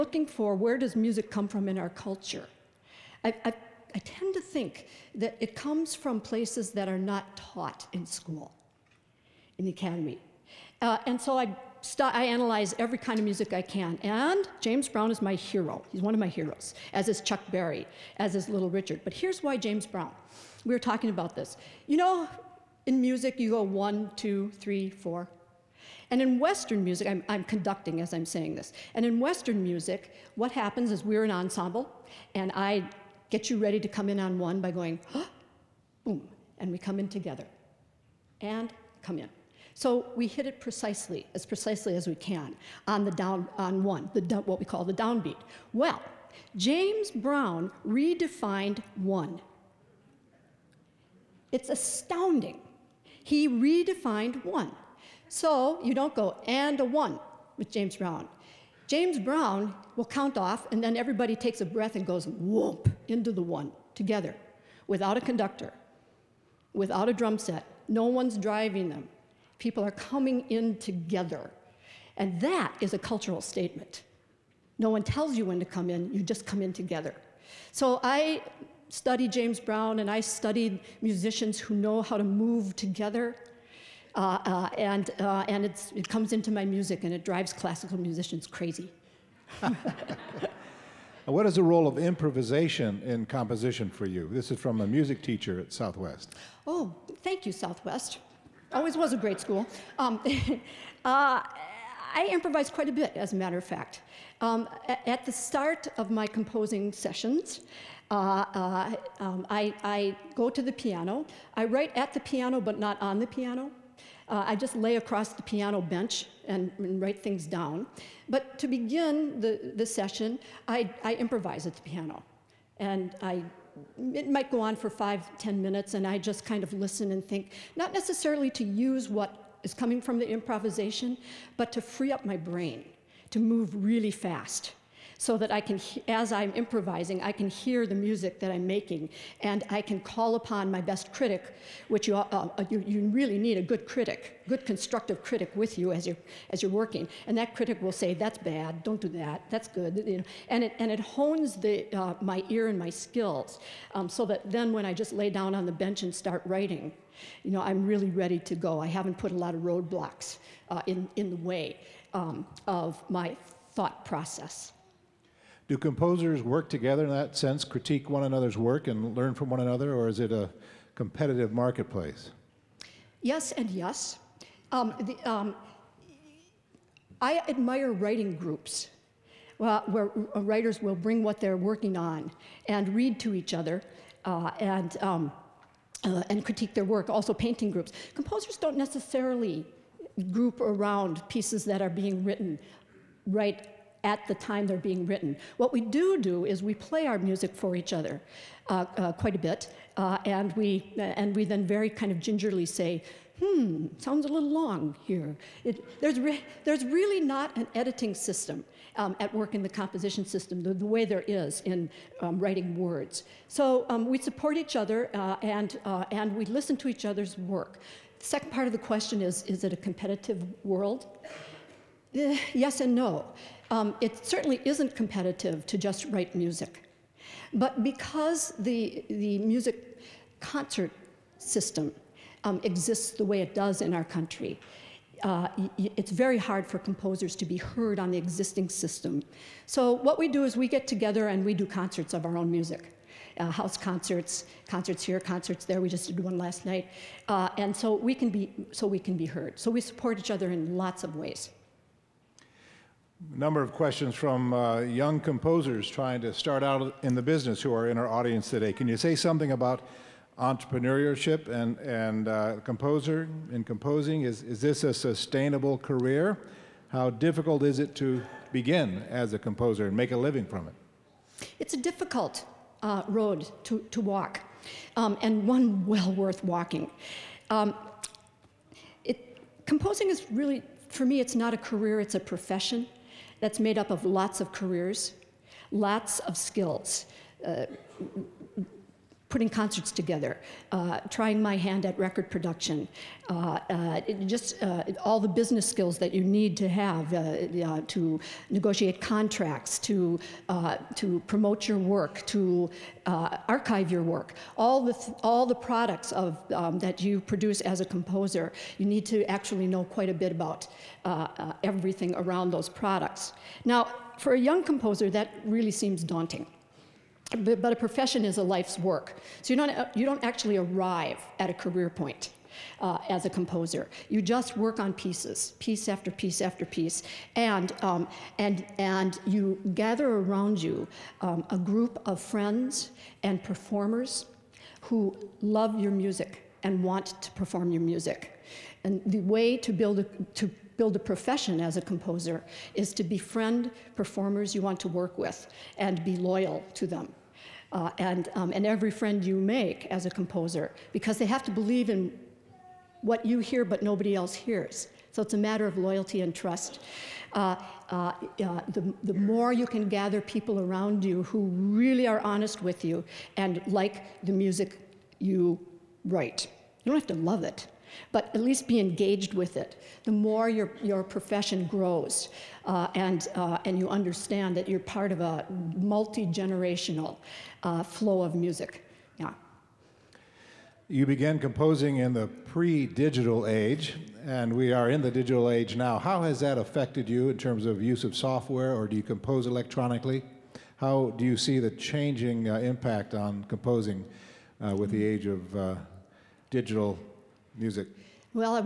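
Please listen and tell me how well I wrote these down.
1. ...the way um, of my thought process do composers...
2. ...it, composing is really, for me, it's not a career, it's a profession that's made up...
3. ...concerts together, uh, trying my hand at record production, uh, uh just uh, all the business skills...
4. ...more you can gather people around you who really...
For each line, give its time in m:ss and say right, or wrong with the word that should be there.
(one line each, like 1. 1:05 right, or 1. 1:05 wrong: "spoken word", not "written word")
1. 2:41 right
2. 4:39 right
3. 4:49 right
4. 5:59 right.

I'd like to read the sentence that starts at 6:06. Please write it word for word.
You don't have to love it, but at least be engaged with it.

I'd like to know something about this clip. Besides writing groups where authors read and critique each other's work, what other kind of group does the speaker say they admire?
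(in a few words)
painting groups.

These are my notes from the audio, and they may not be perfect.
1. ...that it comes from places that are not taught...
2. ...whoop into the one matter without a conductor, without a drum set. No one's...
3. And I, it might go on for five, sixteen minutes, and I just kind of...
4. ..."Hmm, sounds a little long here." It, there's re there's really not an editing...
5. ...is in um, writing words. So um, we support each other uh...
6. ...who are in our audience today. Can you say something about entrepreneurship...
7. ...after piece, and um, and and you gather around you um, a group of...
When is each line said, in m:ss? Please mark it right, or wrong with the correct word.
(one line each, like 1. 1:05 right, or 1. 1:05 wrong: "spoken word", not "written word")
1. 0:05 right
2. 1:02 wrong: "together", not "matter"
3. 2:02 wrong: "ten", not "sixteen"
4. 3:23 right
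5. 3:31 right
6. 4:17 right
7. 5:26 right.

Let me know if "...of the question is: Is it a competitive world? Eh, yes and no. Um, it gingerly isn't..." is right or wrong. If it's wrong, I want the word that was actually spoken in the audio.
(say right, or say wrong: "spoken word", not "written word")
wrong: "certainly", not "gingerly".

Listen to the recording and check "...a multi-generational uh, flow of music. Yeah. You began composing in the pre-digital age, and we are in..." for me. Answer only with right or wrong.
right.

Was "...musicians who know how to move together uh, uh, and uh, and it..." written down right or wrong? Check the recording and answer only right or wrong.
right.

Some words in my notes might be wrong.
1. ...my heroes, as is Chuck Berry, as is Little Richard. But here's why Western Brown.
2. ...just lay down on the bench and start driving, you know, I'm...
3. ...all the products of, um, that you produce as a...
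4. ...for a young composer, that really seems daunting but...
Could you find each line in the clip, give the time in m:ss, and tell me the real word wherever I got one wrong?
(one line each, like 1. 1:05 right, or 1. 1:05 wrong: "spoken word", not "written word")
1. 0:16 wrong: "James", not "Western"
2. 2:34 wrong: "writing", not "driving"
3. 5:05 right
4. 5:14 right.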